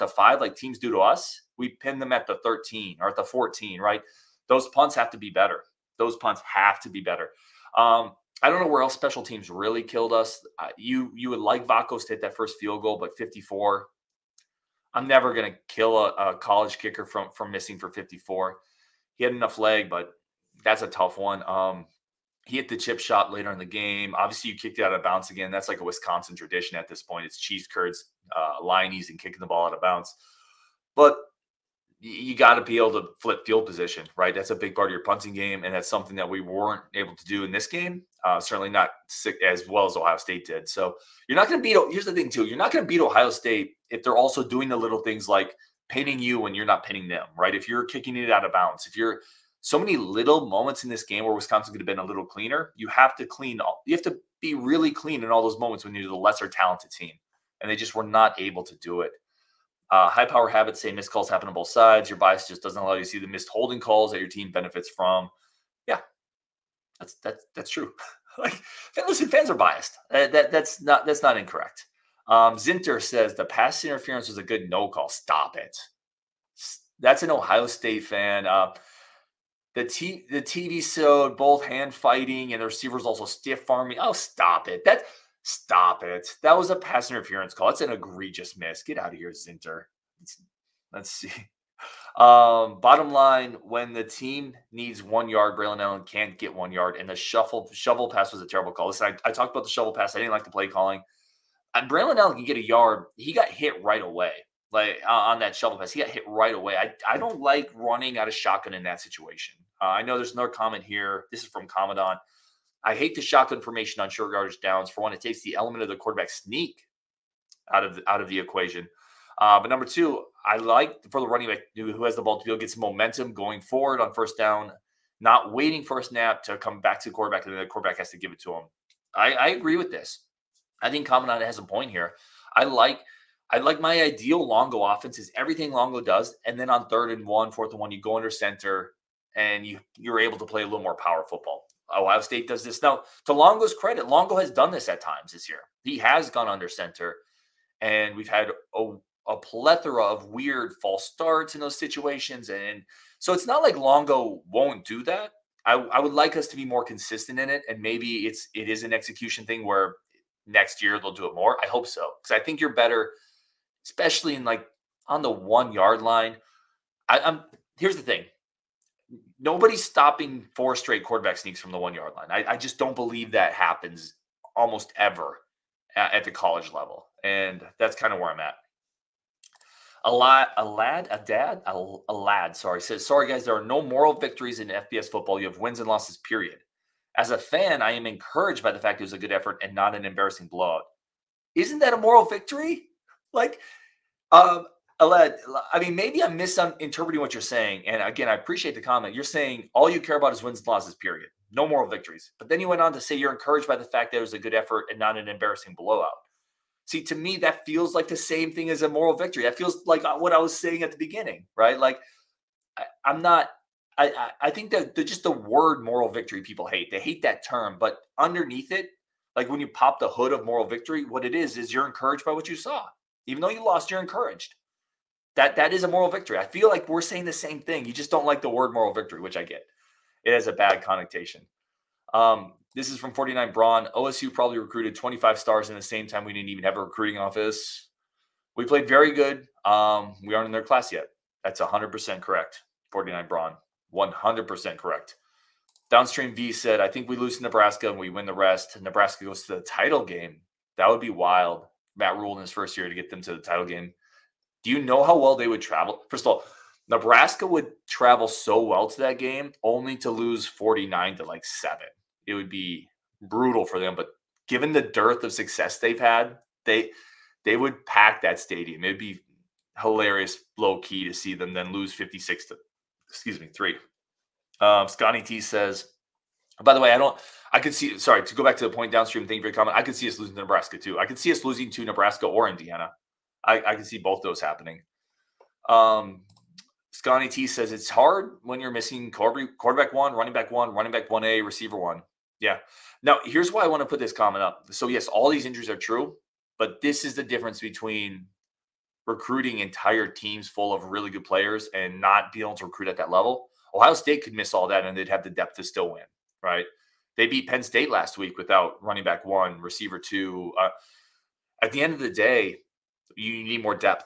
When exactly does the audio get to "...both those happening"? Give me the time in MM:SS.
04:43.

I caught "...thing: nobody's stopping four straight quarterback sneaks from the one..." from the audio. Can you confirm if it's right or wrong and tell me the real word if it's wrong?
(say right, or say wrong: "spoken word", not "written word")
right.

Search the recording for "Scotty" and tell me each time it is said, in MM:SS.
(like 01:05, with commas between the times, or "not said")
04:34, 04:46.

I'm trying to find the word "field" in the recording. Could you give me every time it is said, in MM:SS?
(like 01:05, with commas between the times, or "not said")
00:12, 00:33.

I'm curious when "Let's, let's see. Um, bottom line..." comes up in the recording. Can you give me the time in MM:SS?
01:30.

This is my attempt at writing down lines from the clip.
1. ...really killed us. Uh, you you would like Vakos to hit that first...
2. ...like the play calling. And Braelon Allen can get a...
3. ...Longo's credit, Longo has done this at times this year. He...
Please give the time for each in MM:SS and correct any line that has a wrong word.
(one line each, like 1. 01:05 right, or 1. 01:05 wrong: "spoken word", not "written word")
1. 00:09 right
2. 01:40 right
3. 02:23 right.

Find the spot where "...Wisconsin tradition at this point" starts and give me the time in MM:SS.
00:25.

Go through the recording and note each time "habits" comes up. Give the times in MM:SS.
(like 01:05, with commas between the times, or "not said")
01:00.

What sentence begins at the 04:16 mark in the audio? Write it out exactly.
First of all, Nebraska would travel so well to that game only to lose 49 to like seven.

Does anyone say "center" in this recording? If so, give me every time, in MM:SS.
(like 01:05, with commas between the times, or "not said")
02:18, 02:26.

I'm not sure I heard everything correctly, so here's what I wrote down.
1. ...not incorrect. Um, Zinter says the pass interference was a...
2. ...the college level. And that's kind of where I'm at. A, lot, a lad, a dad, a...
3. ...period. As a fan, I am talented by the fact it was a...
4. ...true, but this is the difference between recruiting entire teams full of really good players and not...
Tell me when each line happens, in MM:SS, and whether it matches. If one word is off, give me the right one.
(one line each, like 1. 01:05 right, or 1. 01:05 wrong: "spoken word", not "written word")
1. 01:11 right
2. 02:56 right
3. 03:06 wrong: "encouraged", not "talented"
4. 04:55 right.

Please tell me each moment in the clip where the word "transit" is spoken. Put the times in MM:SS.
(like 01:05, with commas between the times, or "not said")
not said.